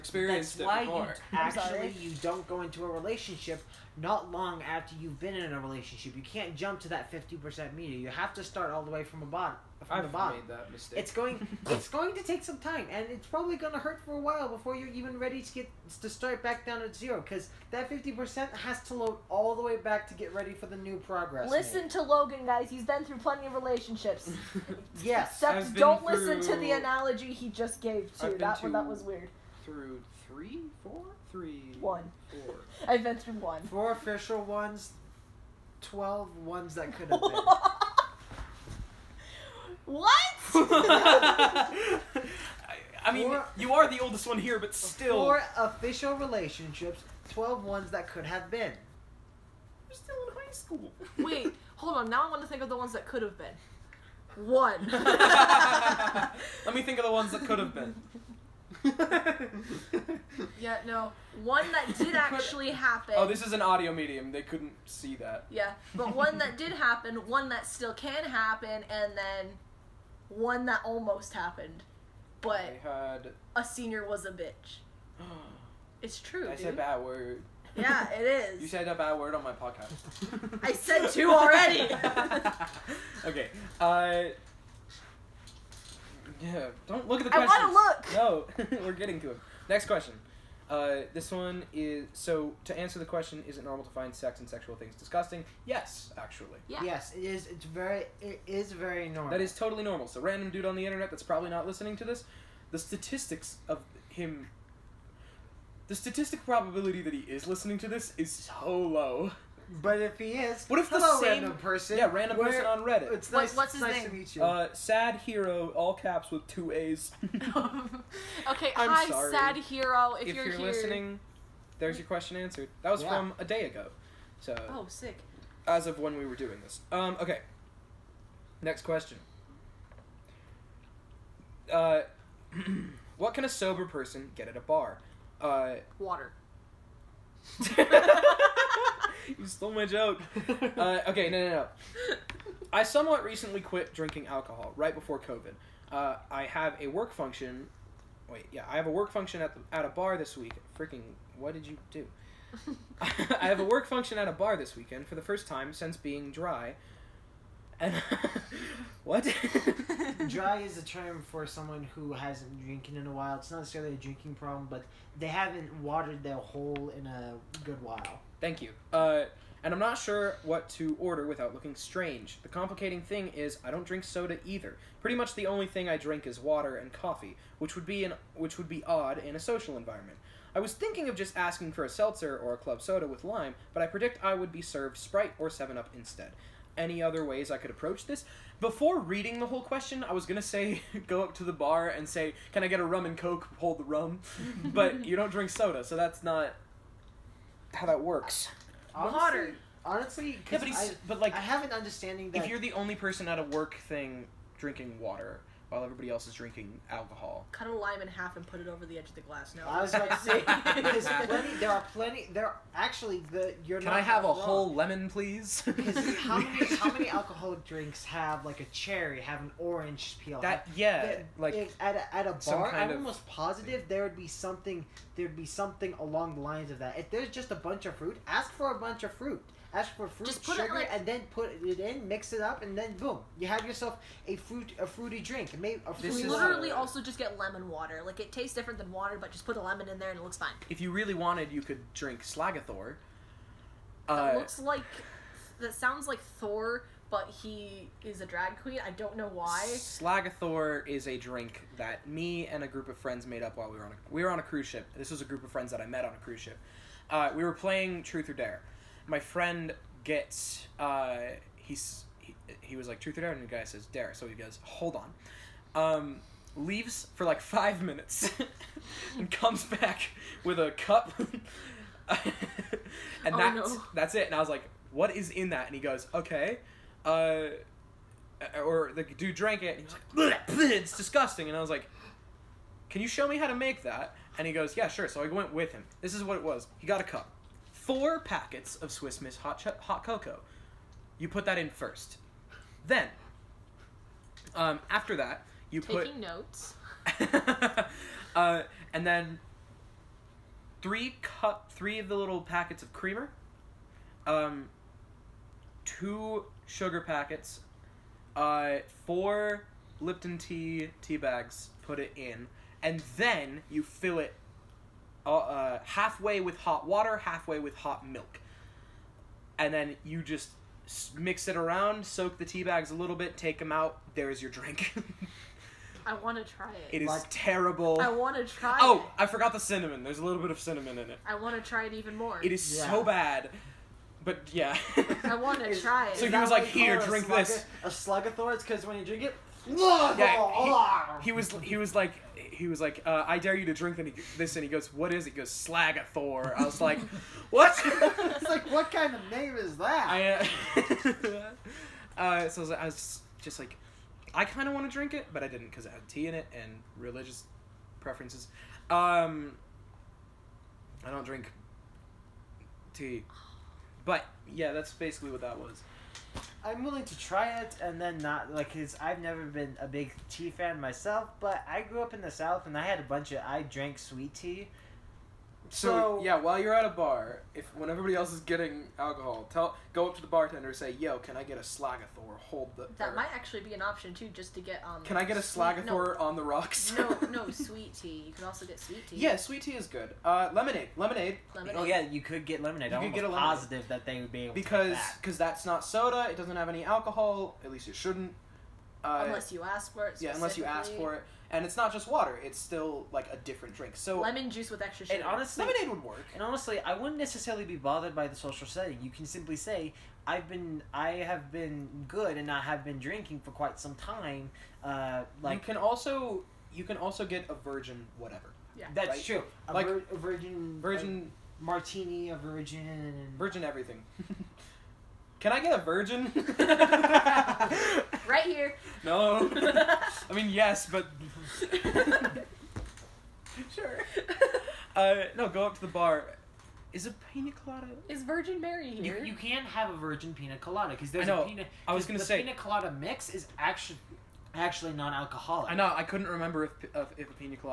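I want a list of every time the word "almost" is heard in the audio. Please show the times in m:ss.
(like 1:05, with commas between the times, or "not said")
1:10, 3:42.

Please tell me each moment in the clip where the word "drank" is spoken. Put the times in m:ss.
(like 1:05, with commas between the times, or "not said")
4:39, 6:13.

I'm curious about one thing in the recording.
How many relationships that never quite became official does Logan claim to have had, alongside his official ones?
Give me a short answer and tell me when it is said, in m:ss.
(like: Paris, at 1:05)
12, at 0:35.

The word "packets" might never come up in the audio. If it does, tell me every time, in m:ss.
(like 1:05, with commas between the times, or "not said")
4:48, 5:02, 5:06.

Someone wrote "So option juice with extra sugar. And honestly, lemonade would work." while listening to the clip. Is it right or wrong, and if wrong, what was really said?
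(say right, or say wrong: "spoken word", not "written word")
wrong: "lemon", not "option".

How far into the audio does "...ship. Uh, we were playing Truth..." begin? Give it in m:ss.
4:16.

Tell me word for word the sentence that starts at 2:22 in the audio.
I somewhat recently quit drinking alcohol right before COVID.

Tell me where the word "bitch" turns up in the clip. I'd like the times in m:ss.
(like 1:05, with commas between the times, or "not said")
1:14.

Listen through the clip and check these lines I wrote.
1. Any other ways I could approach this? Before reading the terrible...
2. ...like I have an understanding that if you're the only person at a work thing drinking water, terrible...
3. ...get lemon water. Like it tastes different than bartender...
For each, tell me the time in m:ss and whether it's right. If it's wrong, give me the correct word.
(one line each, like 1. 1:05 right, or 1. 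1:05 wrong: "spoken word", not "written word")
1. 3:06 wrong: "whole", not "terrible"
2. 3:21 wrong: "while", not "terrible"
3. 3:57 wrong: "water", not "bartender".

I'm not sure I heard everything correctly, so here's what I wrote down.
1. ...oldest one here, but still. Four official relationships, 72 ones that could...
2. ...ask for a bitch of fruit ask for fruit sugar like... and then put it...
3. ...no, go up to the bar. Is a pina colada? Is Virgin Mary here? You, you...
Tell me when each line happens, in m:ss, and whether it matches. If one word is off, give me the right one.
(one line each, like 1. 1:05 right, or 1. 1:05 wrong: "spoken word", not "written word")
1. 0:43 wrong: "12", not "72"
2. 3:48 wrong: "bunch", not "bitch"
3. 7:15 right.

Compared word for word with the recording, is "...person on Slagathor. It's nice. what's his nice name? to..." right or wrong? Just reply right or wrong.
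wrong.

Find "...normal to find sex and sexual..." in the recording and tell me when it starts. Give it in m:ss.
1:33.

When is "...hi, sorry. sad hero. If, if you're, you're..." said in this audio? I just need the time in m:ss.
1:58.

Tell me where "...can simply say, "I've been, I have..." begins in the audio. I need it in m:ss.
6:49.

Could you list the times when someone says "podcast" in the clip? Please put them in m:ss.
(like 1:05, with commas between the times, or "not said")
1:19.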